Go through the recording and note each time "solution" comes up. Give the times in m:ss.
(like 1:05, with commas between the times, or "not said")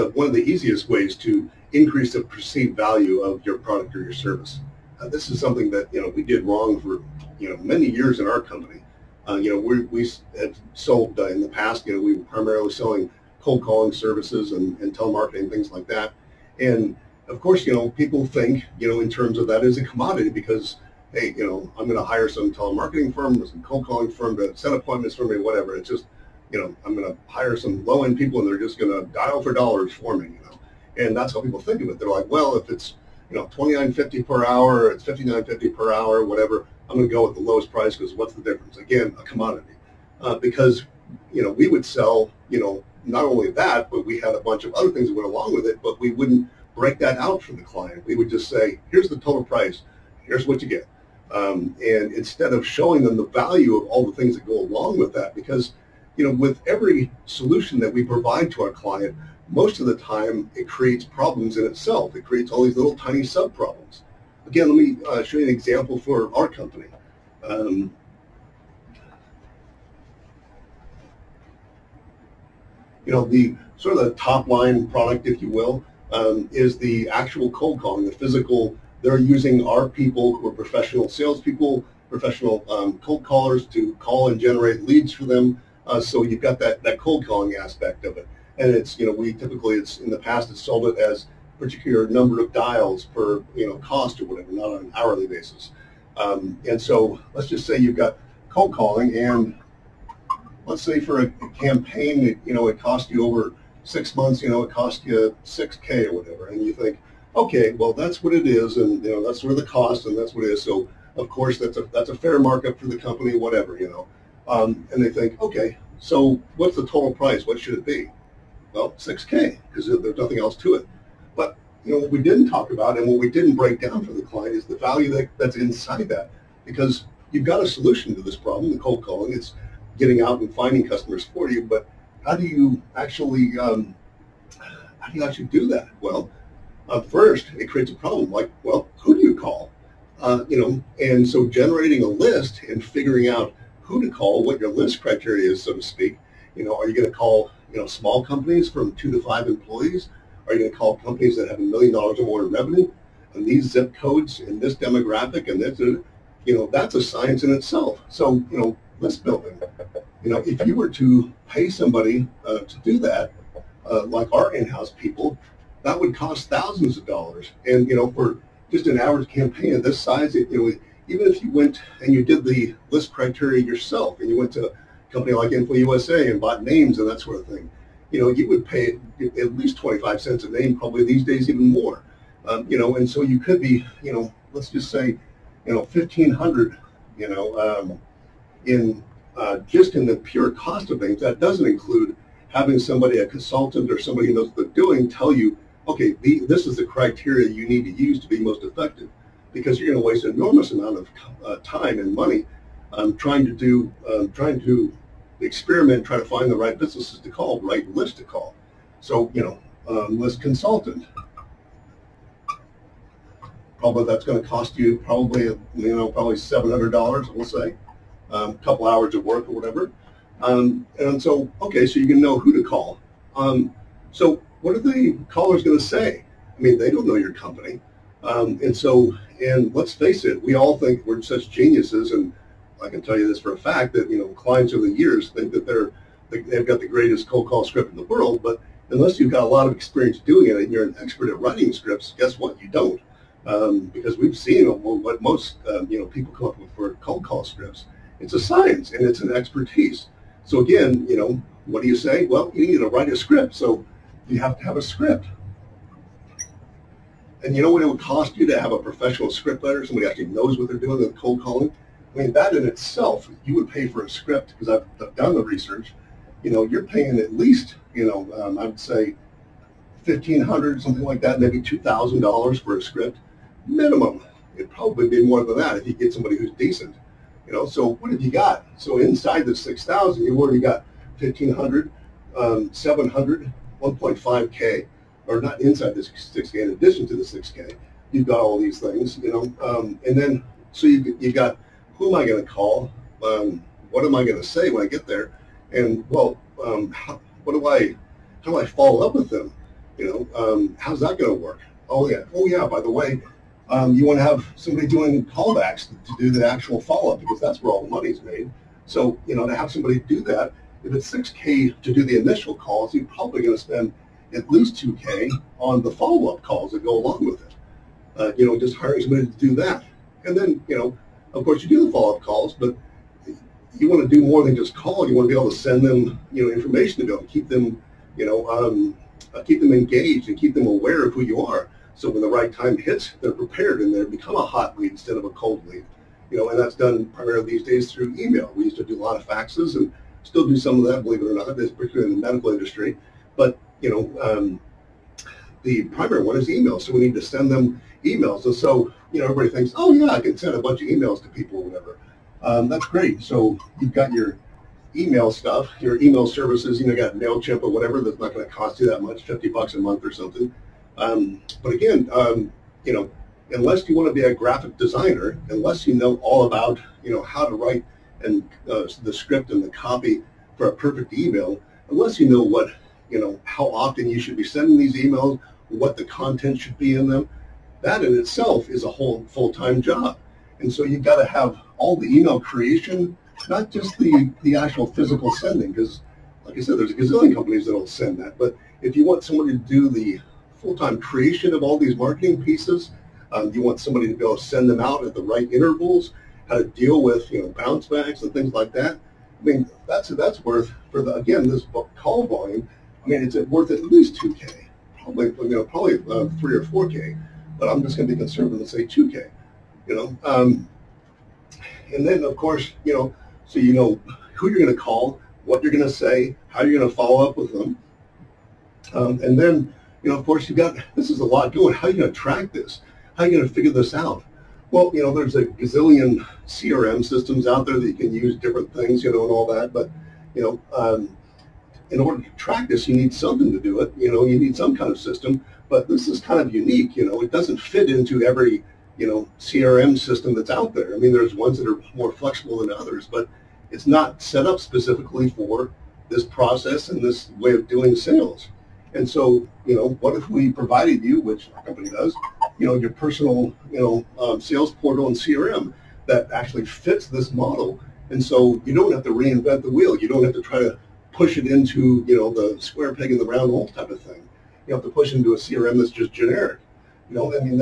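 0:57, 2:07.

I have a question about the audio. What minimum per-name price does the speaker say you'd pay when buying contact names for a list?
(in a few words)
25 cents.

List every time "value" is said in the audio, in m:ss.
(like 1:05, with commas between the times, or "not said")
0:02, 0:53, 2:04.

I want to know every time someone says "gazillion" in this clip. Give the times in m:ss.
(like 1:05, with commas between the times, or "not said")
6:26, 7:05.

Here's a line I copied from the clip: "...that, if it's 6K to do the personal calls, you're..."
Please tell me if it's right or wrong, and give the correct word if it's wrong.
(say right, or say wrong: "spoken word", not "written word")
wrong: "initial", not "personal".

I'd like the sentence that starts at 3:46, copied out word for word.
I mean, they don't know your company.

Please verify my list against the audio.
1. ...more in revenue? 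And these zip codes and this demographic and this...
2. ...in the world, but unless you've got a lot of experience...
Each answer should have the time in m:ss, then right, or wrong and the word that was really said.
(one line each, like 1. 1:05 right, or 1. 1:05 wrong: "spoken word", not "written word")
1. 2:32 right
2. 3:57 right.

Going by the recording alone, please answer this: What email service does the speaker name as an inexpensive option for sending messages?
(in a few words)
MailChimp.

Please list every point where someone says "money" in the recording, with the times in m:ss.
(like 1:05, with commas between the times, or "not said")
3:22, 5:07.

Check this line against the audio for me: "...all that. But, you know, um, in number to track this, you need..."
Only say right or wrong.
wrong.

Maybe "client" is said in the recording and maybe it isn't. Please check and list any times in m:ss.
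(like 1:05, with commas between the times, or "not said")
0:47, 0:58, 2:04, 3:54.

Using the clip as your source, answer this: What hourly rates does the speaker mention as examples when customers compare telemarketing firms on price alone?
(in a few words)
$29.50 or $59.50.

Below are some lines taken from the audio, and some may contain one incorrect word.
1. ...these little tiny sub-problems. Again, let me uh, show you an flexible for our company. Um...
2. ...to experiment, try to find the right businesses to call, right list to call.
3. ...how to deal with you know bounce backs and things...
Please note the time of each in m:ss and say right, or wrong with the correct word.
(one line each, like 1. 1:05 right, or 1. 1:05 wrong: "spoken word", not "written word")
1. 1:02 wrong: "example", not "flexible"
2. 3:24 right
3. 6:36 right.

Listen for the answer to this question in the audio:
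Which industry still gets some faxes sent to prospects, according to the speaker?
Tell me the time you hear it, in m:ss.
5:42.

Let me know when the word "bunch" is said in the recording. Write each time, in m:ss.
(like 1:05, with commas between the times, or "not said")
0:44, 5:50.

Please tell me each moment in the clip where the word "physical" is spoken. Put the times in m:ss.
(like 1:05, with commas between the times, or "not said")
1:18, 6:24.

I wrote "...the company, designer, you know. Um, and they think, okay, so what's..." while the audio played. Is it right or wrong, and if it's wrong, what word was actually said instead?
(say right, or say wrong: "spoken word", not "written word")
wrong: "whatever", not "designer".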